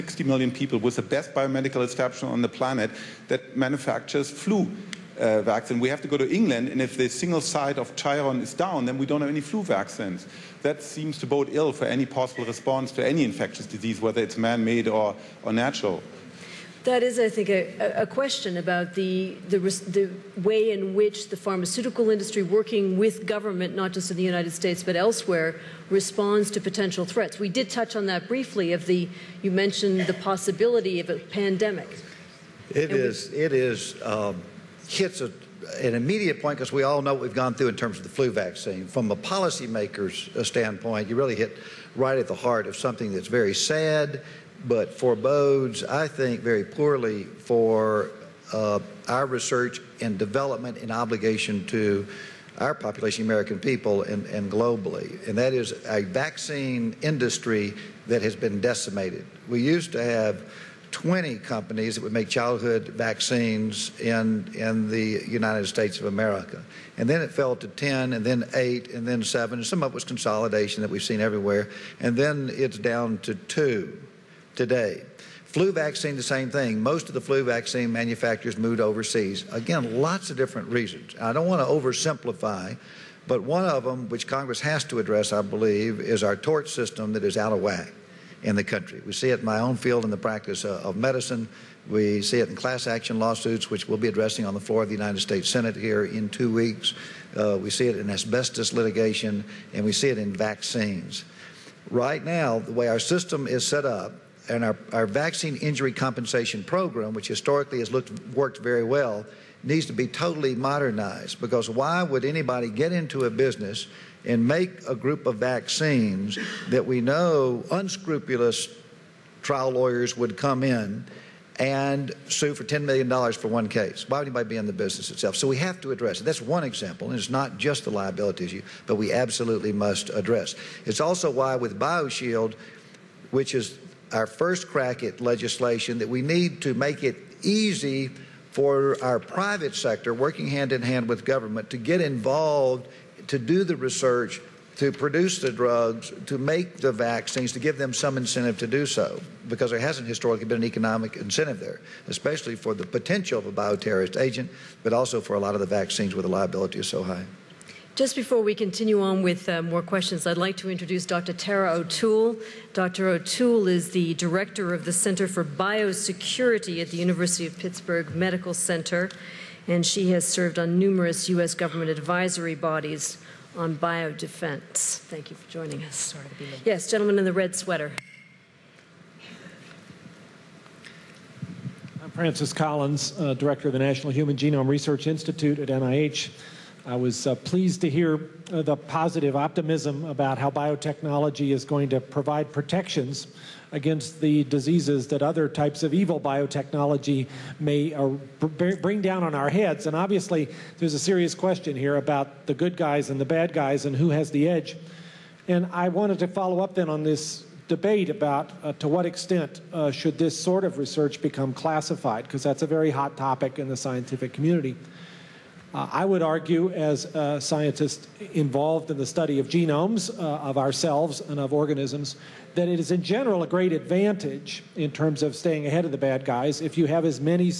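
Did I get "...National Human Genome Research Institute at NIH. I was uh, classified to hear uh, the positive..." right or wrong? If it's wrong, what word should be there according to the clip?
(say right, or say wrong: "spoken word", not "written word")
wrong: "pleased", not "classified".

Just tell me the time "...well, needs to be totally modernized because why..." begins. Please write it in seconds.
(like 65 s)
108 s.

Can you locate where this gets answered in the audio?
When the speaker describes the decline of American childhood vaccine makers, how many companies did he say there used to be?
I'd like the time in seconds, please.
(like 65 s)
60 s.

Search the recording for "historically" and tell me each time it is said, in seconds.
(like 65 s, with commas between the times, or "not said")
107 s, 150 s.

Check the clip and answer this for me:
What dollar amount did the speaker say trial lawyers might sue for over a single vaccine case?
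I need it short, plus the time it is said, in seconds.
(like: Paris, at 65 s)
$10 million, at 122 s.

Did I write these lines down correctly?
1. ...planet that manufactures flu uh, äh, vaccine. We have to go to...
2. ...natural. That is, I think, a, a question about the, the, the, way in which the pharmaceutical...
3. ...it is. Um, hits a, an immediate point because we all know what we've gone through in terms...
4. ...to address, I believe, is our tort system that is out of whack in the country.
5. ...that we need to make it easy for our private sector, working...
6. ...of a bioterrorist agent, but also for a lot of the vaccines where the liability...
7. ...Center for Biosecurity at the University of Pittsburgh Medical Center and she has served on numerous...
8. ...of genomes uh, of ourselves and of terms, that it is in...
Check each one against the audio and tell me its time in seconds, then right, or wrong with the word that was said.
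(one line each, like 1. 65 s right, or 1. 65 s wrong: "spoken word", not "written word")
1. 2 s right
2. 15 s right
3. 33 s right
4. 84 s right
5. 135 s right
6. 153 s right
7. 164 s right
8. 219 s wrong: "organisms", not "terms".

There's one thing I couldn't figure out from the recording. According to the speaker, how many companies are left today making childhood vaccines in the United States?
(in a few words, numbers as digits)
2.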